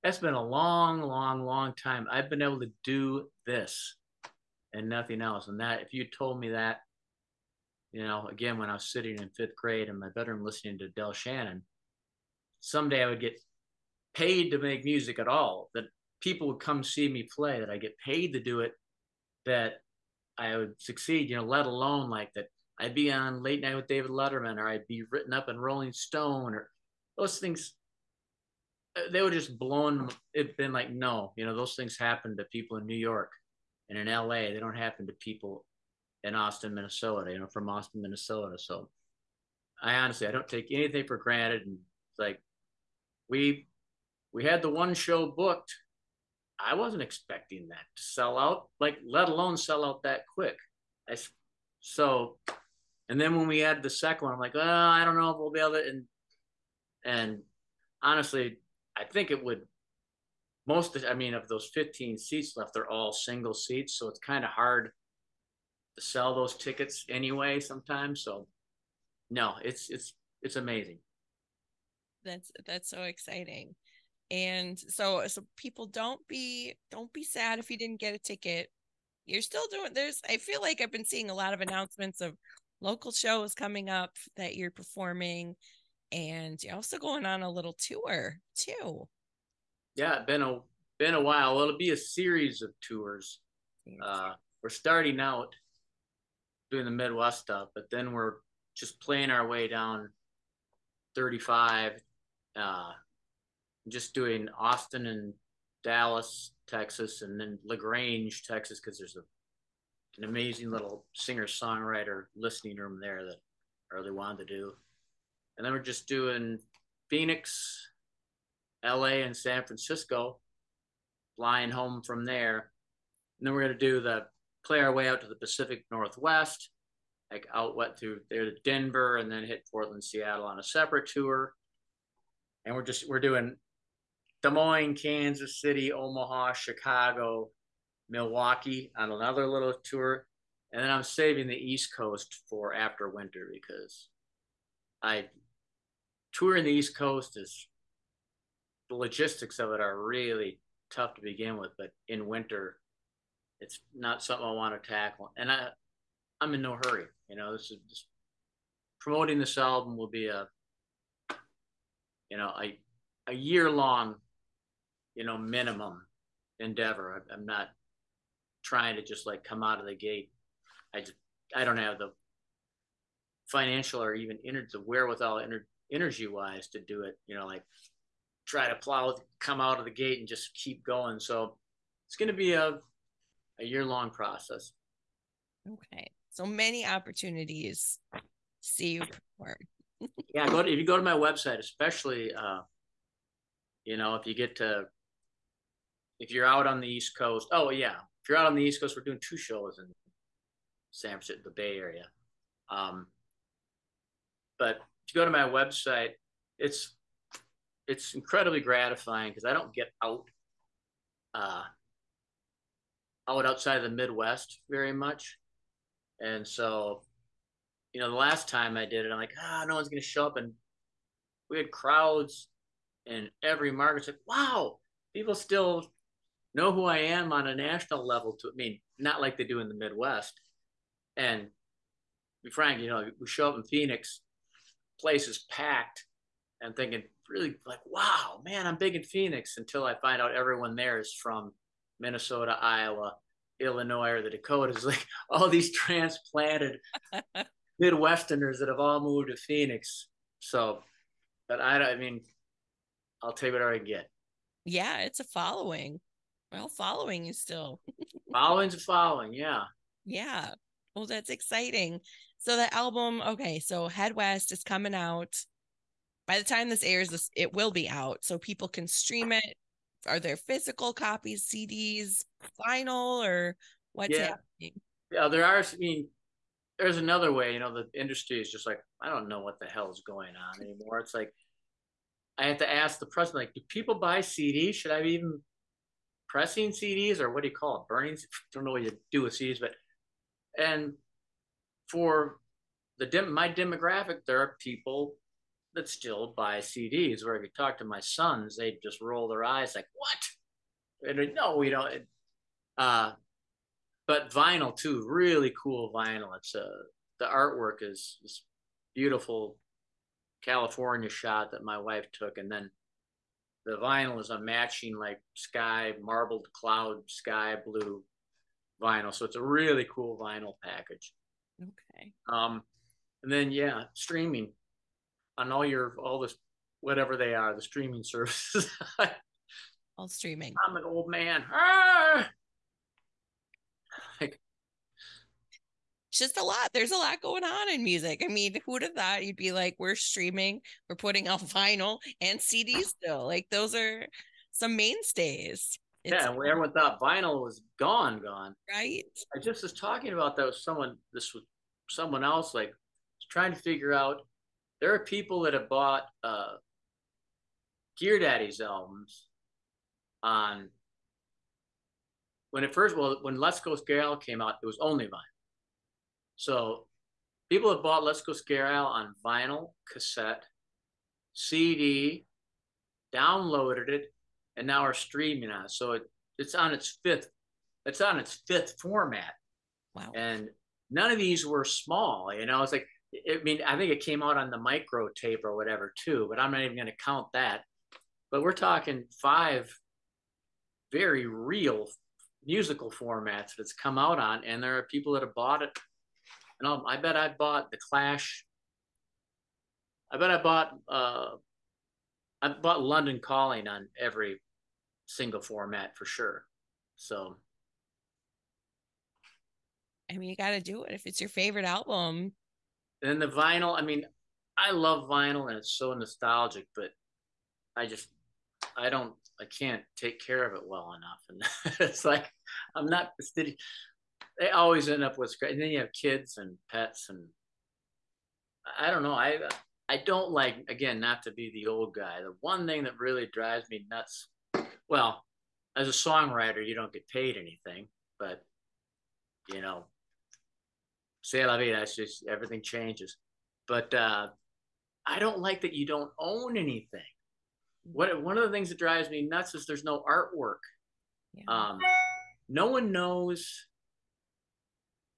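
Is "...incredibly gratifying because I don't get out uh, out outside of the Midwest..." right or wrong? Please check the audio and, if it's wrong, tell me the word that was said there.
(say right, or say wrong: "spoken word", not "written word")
right.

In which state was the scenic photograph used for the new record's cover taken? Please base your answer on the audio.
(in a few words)
California.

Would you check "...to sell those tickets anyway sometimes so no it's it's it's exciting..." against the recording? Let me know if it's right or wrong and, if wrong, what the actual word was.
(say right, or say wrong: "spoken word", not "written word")
wrong: "amazing", not "exciting".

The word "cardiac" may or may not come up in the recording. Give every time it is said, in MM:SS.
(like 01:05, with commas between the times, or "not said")
not said.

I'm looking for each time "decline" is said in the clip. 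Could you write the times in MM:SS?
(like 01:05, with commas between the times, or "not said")
not said.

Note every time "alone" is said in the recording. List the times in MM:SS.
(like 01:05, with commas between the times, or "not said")
00:21, 00:49.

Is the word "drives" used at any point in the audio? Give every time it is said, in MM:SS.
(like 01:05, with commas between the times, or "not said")
07:13, 07:28.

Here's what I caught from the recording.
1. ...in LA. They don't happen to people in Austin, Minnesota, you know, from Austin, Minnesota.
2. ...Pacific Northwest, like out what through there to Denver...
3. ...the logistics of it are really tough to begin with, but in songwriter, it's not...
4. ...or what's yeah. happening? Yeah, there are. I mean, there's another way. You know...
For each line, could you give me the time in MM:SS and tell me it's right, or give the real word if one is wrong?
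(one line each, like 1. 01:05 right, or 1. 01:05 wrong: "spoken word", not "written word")
1. 00:33 right
2. 02:05 right
3. 02:28 wrong: "winter", not "songwriter"
4. 04:33 right.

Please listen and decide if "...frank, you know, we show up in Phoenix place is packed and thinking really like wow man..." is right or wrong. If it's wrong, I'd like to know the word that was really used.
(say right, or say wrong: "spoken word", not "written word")
right.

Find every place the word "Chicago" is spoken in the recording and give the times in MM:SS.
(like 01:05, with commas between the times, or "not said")
02:16.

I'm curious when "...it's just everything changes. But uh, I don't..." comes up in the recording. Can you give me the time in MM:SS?
07:21.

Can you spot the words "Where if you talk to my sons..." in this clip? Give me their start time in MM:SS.
04:57.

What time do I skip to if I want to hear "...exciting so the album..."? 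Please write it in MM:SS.
04:21.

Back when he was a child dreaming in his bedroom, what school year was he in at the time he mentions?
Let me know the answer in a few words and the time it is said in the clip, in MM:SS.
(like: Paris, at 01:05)
fifth grade, at 00:09.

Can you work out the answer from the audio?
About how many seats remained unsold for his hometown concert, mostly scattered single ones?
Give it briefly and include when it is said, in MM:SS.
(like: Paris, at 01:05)
15, at 01:01.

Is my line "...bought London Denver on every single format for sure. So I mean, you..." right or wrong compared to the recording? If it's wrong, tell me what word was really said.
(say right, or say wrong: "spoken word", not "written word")
wrong: "Calling", not "Denver".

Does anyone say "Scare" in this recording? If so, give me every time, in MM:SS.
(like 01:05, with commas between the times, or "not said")
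06:03, 06:08.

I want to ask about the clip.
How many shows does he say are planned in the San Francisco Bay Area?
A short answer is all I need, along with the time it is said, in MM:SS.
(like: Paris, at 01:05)
2, at 03:19.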